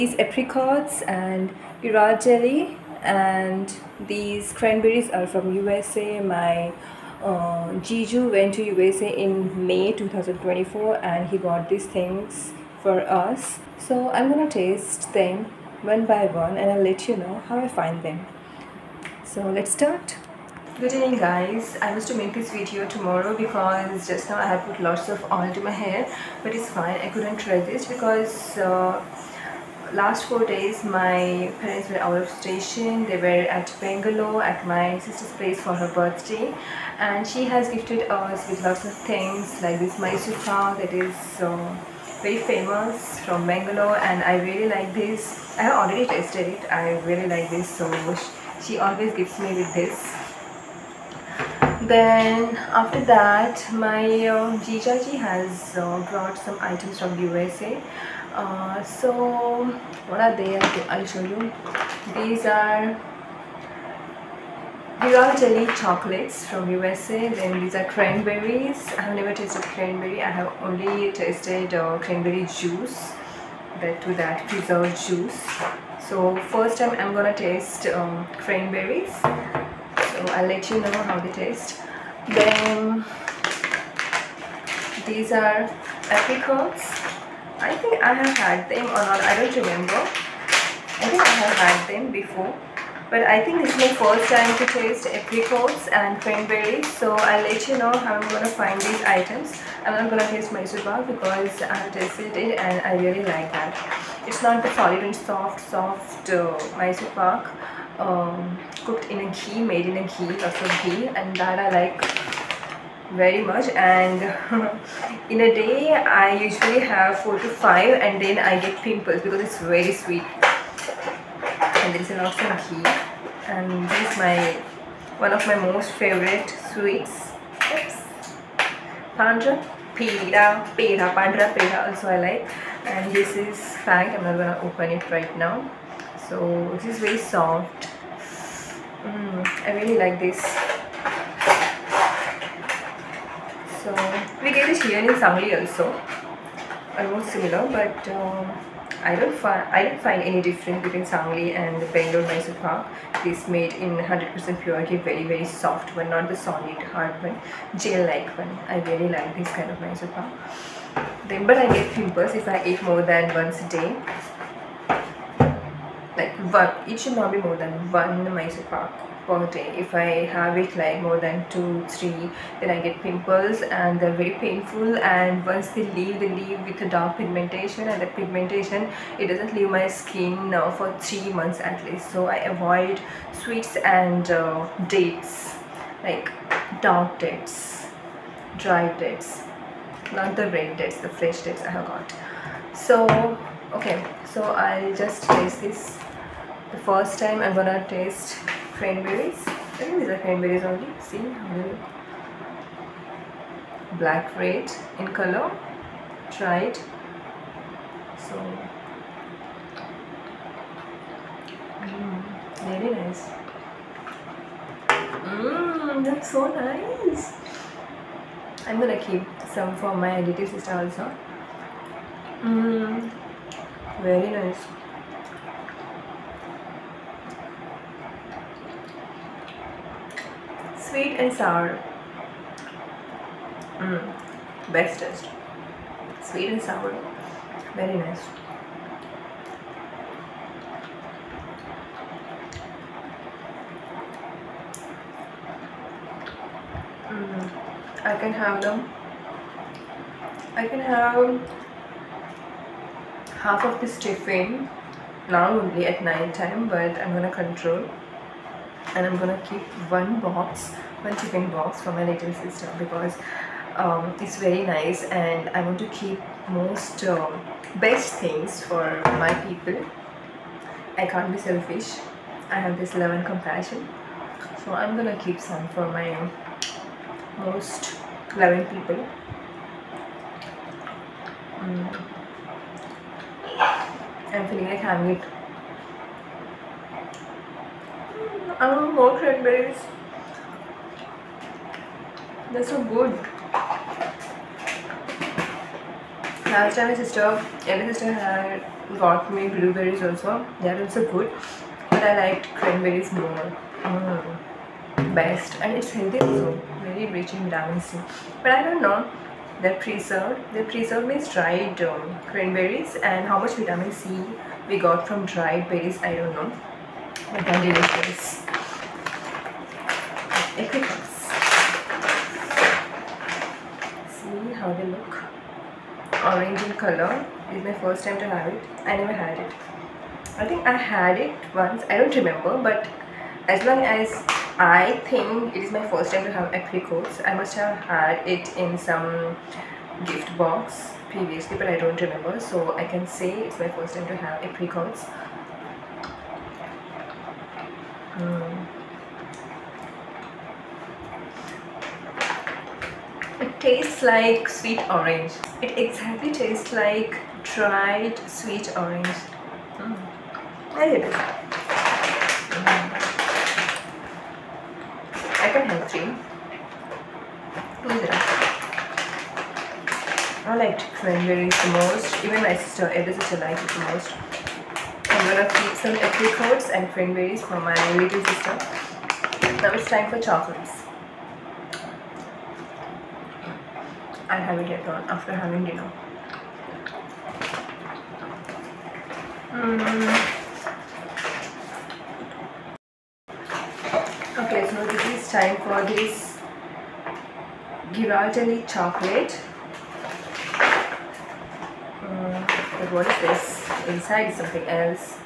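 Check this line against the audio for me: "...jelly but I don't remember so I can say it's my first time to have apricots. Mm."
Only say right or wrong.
wrong.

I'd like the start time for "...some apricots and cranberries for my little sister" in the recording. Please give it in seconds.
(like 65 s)
375 s.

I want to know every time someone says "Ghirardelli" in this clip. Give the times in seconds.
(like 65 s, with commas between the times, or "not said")
1 s, 397 s.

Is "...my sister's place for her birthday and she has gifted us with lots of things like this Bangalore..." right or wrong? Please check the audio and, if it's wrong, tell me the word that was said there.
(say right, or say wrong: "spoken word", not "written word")
wrong: "Mysore", not "Bangalore".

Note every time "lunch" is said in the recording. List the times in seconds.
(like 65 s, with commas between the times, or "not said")
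not said.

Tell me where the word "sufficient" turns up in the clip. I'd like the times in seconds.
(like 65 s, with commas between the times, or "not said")
not said.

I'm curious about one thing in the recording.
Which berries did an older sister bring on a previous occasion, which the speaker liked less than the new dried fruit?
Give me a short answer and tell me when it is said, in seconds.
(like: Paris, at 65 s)
Blueberries, at 299 s.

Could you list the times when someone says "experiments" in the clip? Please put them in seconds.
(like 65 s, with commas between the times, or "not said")
not said.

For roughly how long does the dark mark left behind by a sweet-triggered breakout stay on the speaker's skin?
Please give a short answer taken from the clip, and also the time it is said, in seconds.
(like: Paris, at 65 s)
3 months, at 180 s.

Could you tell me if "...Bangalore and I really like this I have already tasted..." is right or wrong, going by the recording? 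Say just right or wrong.
right.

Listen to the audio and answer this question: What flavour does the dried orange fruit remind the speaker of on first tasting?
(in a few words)
Dried sweet orange.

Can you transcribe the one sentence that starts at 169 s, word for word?
If I have it like more than two, three, then I get pimples and they're very painful.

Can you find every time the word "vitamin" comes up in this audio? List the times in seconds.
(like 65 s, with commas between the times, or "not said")
307 s, 313 s.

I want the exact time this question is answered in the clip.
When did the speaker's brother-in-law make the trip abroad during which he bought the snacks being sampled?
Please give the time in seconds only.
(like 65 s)
9 s.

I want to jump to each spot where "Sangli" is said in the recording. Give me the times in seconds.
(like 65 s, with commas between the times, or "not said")
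145 s, 151 s.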